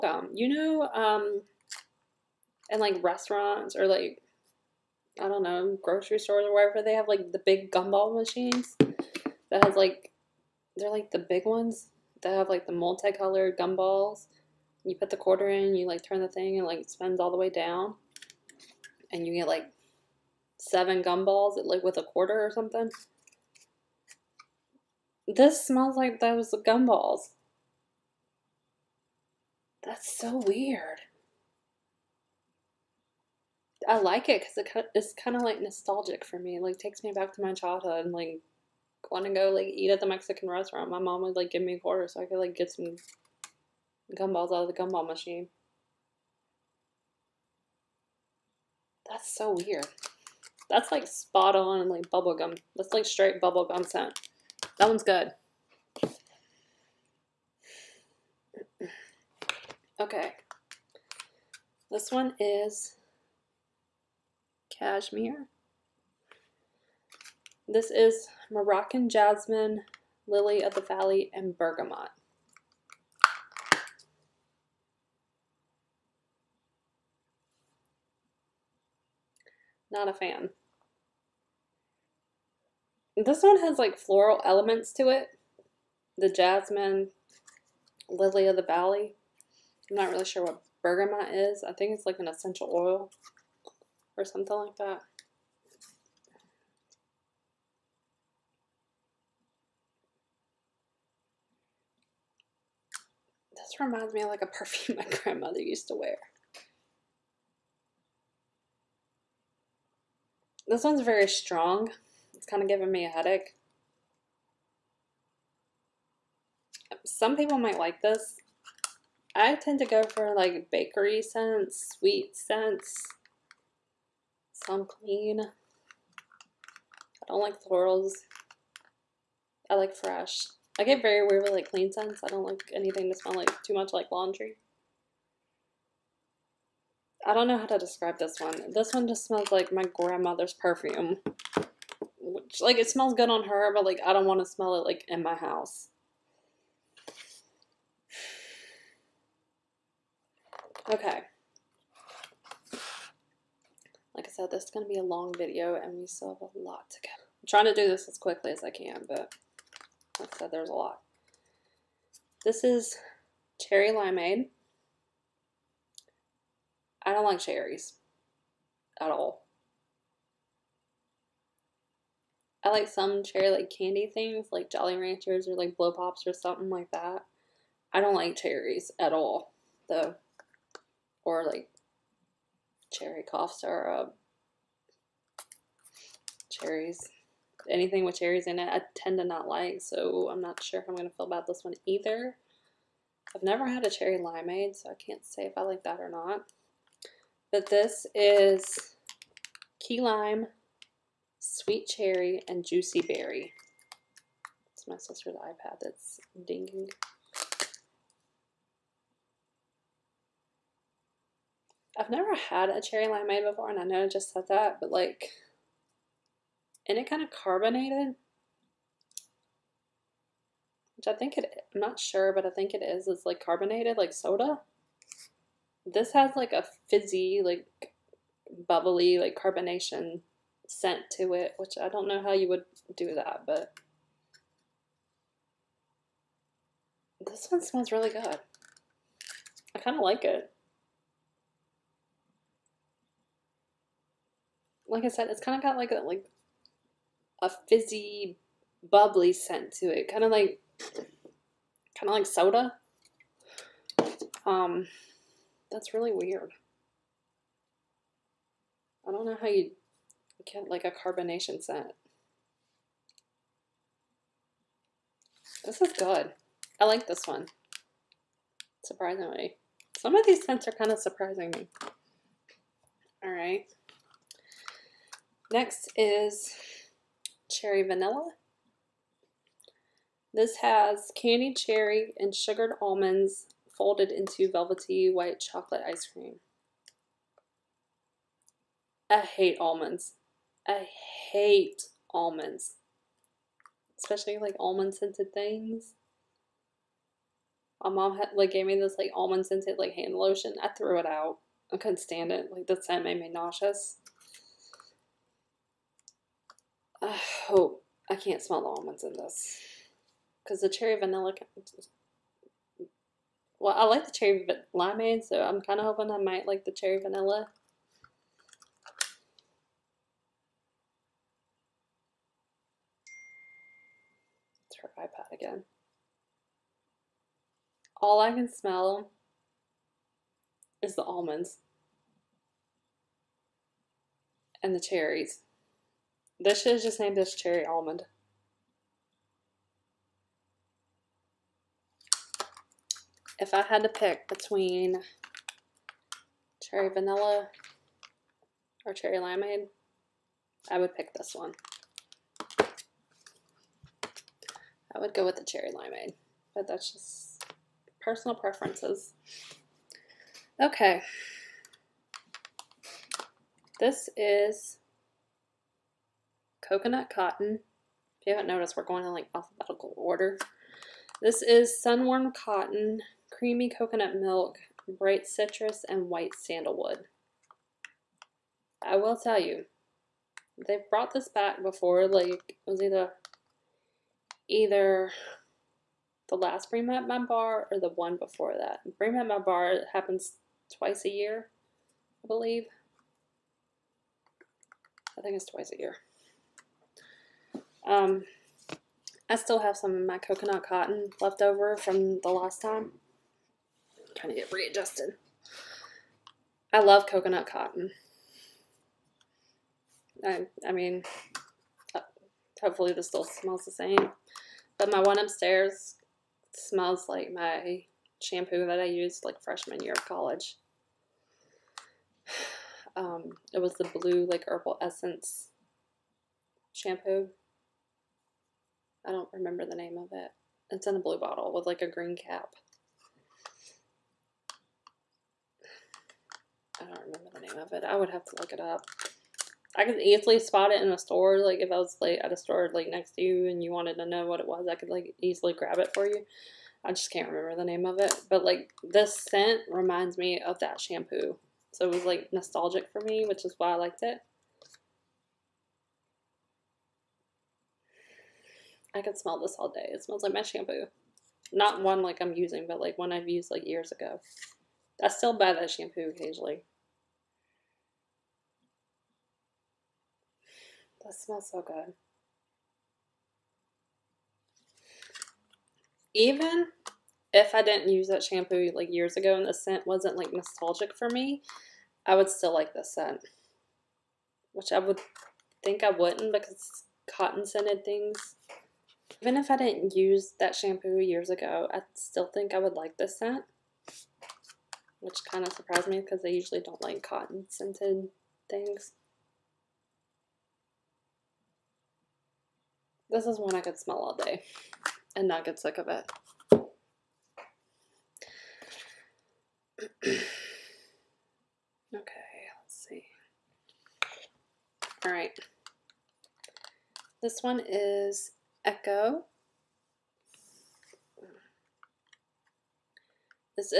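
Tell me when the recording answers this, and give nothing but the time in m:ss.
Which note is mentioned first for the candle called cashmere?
1:08.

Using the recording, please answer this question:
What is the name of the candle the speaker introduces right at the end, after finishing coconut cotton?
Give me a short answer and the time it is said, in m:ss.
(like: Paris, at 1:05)
Echo, at 8:38.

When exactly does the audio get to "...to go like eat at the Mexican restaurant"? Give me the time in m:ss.
0:39.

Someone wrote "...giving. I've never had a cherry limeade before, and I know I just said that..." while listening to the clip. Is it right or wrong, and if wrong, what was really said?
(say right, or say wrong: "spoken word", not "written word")
wrong: "dinging", not "giving".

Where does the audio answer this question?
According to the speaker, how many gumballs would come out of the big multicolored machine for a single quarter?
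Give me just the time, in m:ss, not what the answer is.
0:20.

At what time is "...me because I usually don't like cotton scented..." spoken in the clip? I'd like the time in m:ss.
8:15.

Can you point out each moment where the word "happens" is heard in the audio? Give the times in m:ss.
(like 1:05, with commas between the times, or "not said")
6:29.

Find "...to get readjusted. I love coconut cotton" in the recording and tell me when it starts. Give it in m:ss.
6:44.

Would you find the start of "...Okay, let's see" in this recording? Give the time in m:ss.
8:31.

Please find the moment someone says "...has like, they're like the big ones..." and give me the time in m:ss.
0:09.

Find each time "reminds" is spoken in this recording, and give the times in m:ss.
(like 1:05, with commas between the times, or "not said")
1:43, 7:29.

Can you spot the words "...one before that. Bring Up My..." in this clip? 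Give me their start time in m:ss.
6:27.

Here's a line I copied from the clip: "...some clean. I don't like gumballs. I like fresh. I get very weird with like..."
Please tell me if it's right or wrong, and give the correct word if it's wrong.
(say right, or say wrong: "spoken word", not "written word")
wrong: "florals", not "gumballs".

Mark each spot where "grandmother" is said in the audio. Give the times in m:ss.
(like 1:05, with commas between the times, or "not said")
1:45, 2:19.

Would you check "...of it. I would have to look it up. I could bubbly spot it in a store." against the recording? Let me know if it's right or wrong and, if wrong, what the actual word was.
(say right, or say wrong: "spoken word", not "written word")
wrong: "easily", not "bubbly".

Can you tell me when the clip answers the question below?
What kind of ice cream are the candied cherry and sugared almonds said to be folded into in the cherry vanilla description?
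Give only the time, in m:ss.
4:45.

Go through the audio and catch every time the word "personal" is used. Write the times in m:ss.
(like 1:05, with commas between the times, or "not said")
5:58.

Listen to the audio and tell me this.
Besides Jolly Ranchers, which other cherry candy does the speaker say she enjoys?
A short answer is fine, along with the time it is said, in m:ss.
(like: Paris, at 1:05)
Blow Pops, at 2:55.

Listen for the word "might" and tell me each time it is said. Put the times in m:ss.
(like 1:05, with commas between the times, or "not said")
1:57, 5:16.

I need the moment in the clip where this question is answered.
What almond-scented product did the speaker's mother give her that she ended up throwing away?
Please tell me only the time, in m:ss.
4:59.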